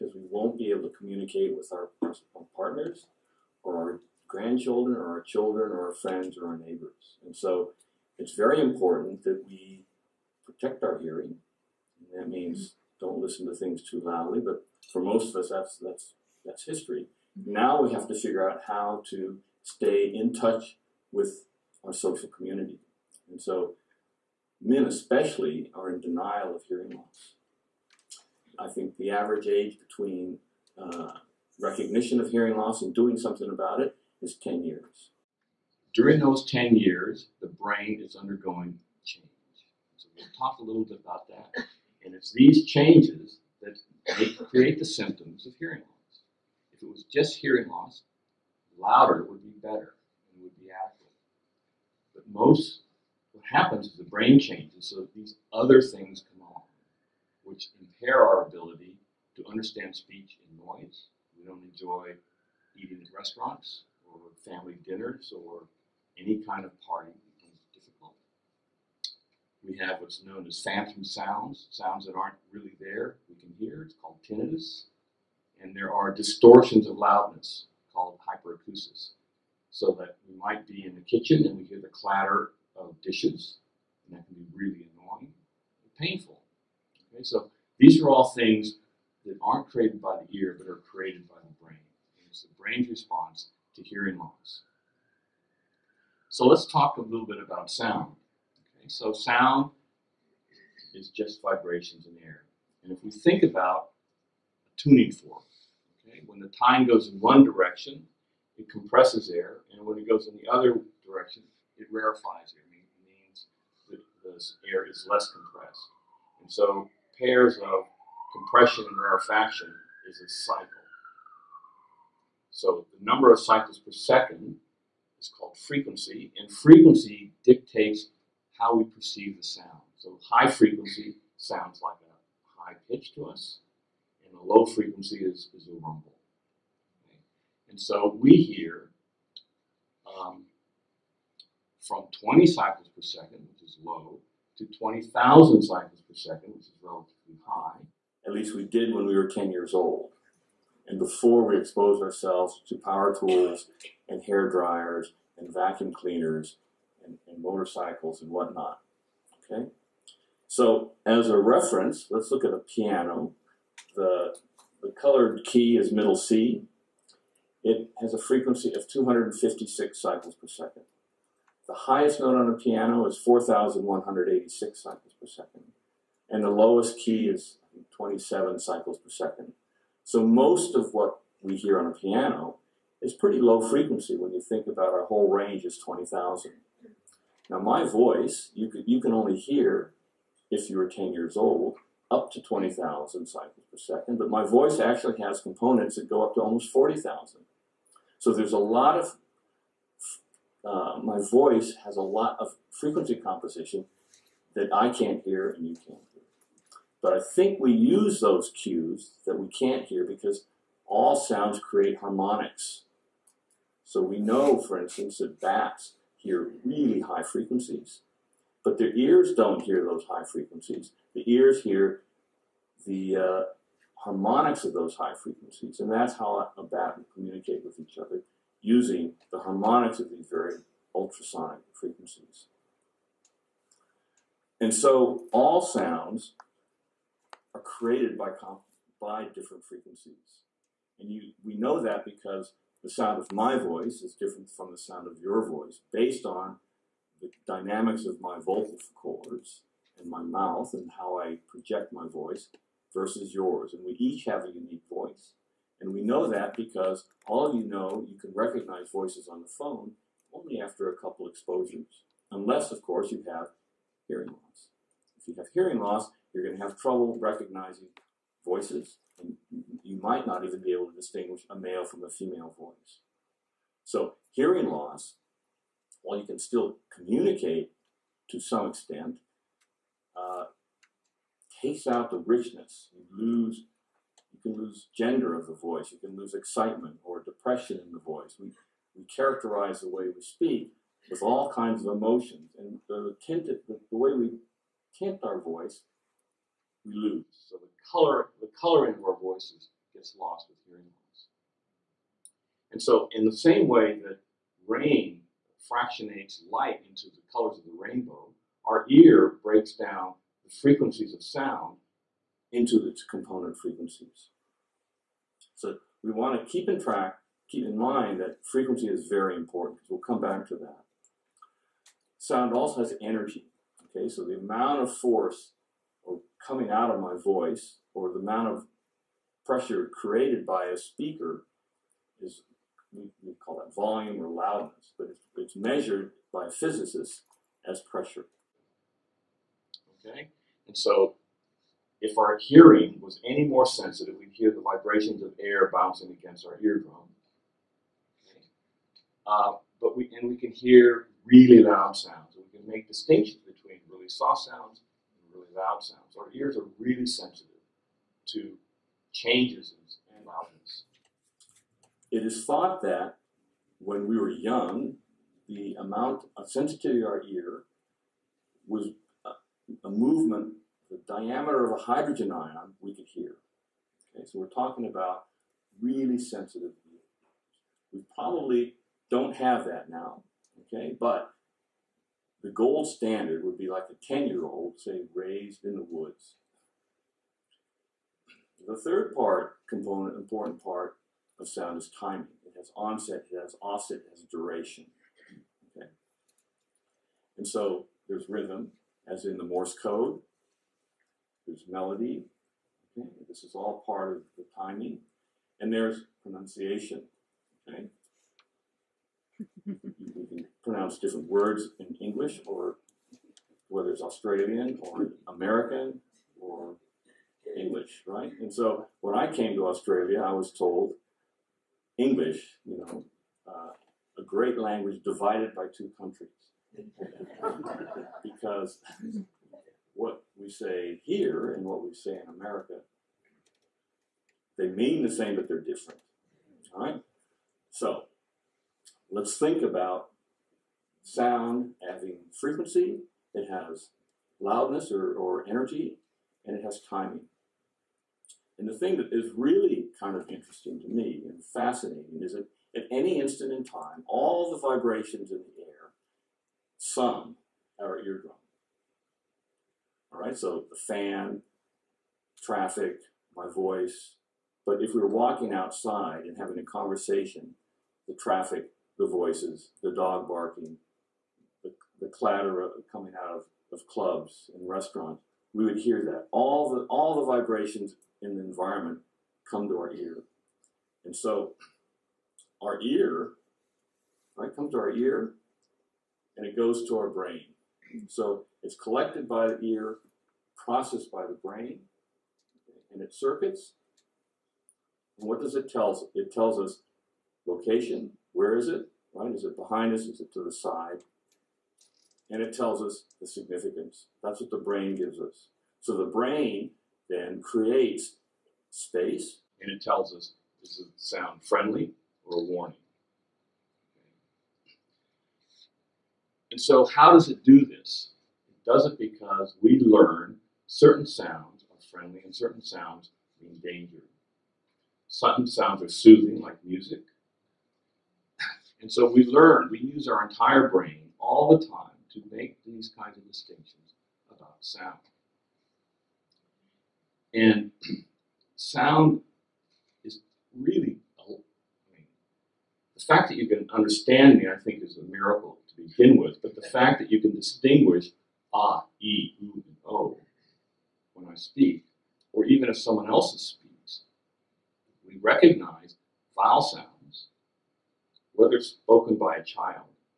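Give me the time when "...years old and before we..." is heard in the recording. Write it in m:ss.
2:29.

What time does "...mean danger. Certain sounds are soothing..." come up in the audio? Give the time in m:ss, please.
8:43.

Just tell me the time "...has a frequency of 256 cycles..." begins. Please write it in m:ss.
2:48.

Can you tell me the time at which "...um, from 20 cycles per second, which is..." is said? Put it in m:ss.
2:20.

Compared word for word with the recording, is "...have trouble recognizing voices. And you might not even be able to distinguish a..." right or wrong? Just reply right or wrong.
right.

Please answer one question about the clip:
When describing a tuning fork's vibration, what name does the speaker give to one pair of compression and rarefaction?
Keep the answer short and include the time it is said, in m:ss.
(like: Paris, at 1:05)
cycle, at 2:00.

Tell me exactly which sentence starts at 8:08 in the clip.
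So it's collected by the ear, processed by the brain, and it circuits.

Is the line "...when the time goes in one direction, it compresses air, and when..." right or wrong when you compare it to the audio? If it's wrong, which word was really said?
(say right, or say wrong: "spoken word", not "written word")
right.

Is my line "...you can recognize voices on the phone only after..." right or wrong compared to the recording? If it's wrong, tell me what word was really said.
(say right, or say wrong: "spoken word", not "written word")
right.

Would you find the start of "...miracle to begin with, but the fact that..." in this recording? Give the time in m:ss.
9:05.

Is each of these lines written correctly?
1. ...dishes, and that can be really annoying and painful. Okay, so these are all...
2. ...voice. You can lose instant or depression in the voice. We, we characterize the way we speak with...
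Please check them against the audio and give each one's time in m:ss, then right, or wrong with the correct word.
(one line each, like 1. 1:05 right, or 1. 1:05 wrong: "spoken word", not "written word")
1. 1:23 right
2. 4:45 wrong: "excitement", not "instant".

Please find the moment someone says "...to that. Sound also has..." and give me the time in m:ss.
5:20.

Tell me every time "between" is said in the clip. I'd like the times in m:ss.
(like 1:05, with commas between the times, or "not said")
0:29, 5:53.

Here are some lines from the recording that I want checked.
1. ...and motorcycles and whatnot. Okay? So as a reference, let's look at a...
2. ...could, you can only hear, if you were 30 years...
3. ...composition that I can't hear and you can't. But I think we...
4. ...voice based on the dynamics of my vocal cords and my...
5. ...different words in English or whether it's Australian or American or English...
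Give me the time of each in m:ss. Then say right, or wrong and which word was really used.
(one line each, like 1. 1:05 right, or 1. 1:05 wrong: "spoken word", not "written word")
1. 2:37 right
2. 3:08 wrong: "10", not "30"
3. 3:23 right
4. 4:05 right
5. 6:51 right.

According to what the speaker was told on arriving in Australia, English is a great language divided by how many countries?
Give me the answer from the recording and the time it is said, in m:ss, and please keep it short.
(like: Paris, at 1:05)
2, at 7:05.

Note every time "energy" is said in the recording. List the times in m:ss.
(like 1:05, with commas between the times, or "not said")
5:23, 7:25.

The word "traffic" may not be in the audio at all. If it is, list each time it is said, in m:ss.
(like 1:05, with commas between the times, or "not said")
7:42, 7:48.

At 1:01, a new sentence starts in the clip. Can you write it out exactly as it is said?
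We don't enjoy eating at restaurants or family dinners or any kind of party becomes difficult.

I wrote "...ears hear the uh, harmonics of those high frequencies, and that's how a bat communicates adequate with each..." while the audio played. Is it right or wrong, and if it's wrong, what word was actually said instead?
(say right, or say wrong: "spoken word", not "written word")
wrong: "communicate", not "adequate".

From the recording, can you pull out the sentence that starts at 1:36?
So let's talk a little bit about sound.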